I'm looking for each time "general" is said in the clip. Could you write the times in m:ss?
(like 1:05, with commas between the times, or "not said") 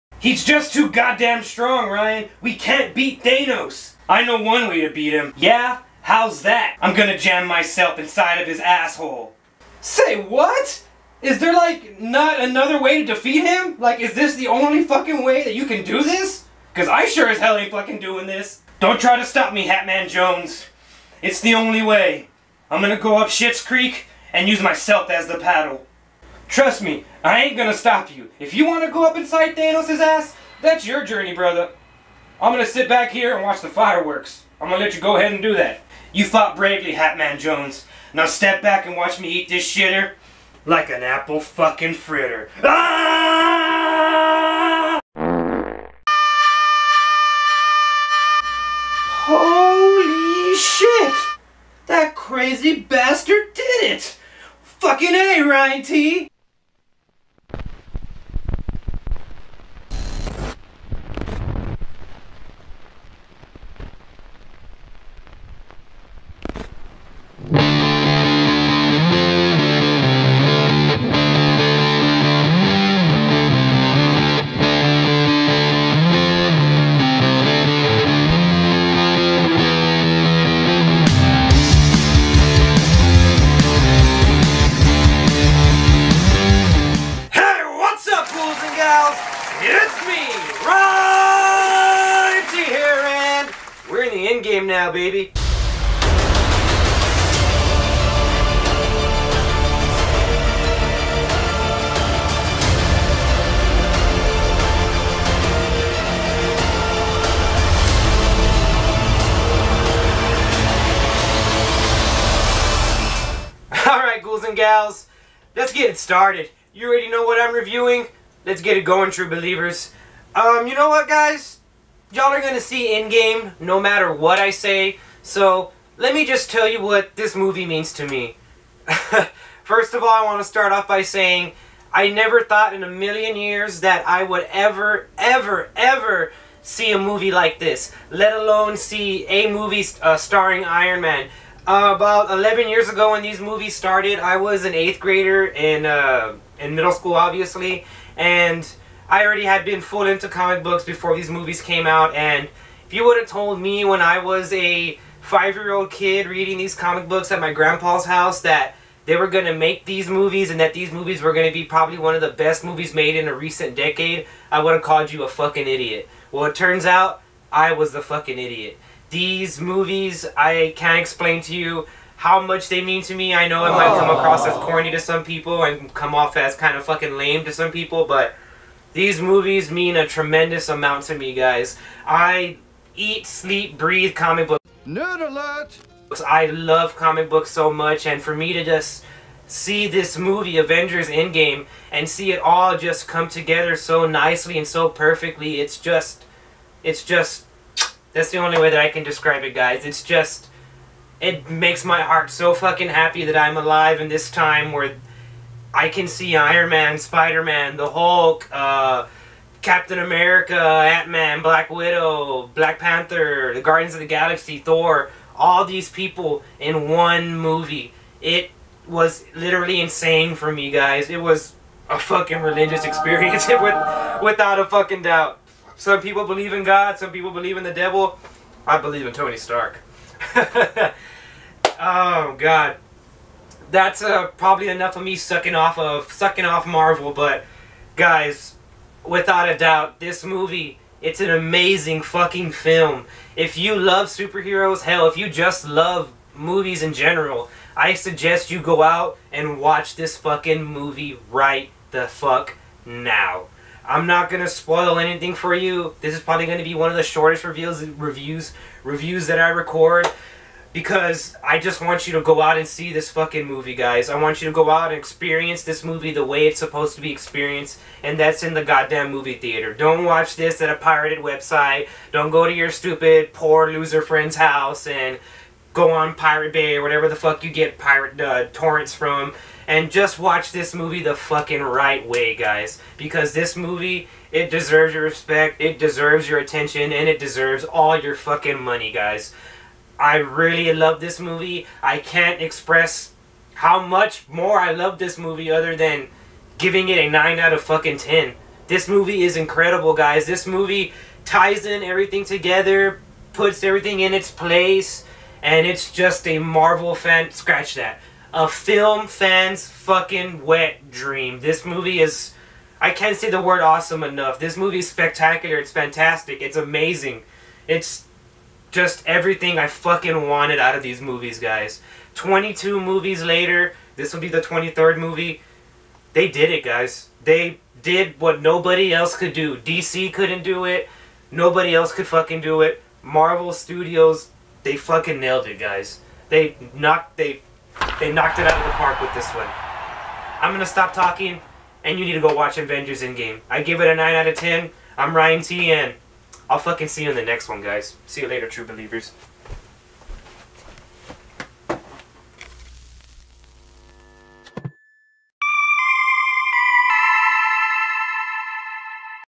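4:06.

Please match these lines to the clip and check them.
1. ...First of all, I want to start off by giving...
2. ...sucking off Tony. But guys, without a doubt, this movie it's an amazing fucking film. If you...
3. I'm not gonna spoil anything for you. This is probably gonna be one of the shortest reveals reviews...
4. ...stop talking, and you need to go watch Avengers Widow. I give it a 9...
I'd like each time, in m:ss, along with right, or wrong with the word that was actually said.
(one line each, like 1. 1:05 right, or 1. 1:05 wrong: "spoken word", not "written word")
1. 2:09 wrong: "saying", not "giving"
2. 3:56 wrong: "Marvel", not "Tony"
3. 4:13 right
4. 5:40 wrong: "Endgame", not "Widow".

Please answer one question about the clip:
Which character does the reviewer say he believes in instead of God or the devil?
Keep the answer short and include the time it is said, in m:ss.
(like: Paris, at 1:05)
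Tony Stark, at 3:49.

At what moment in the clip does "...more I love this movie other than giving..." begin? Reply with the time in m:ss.
4:54.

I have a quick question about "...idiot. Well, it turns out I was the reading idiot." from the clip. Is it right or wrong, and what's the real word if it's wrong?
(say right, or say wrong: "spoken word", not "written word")
wrong: "fucking", not "reading".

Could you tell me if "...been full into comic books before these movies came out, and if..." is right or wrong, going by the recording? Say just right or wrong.
right.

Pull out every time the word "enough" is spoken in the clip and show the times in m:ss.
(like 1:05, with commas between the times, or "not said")
3:54, 5:14.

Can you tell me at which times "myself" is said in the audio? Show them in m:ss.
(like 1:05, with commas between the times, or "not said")
0:07, 0:24.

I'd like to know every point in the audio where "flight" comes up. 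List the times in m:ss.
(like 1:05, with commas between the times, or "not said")
not said.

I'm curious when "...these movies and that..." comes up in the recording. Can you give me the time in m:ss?
2:39.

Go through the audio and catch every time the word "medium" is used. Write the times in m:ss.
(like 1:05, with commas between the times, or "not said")
not said.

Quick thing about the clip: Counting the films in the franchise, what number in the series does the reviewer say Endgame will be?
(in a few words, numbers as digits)
23rd.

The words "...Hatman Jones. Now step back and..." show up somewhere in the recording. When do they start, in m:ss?
0:36.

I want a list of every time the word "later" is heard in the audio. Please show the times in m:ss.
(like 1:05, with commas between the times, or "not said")
5:23, 5:48.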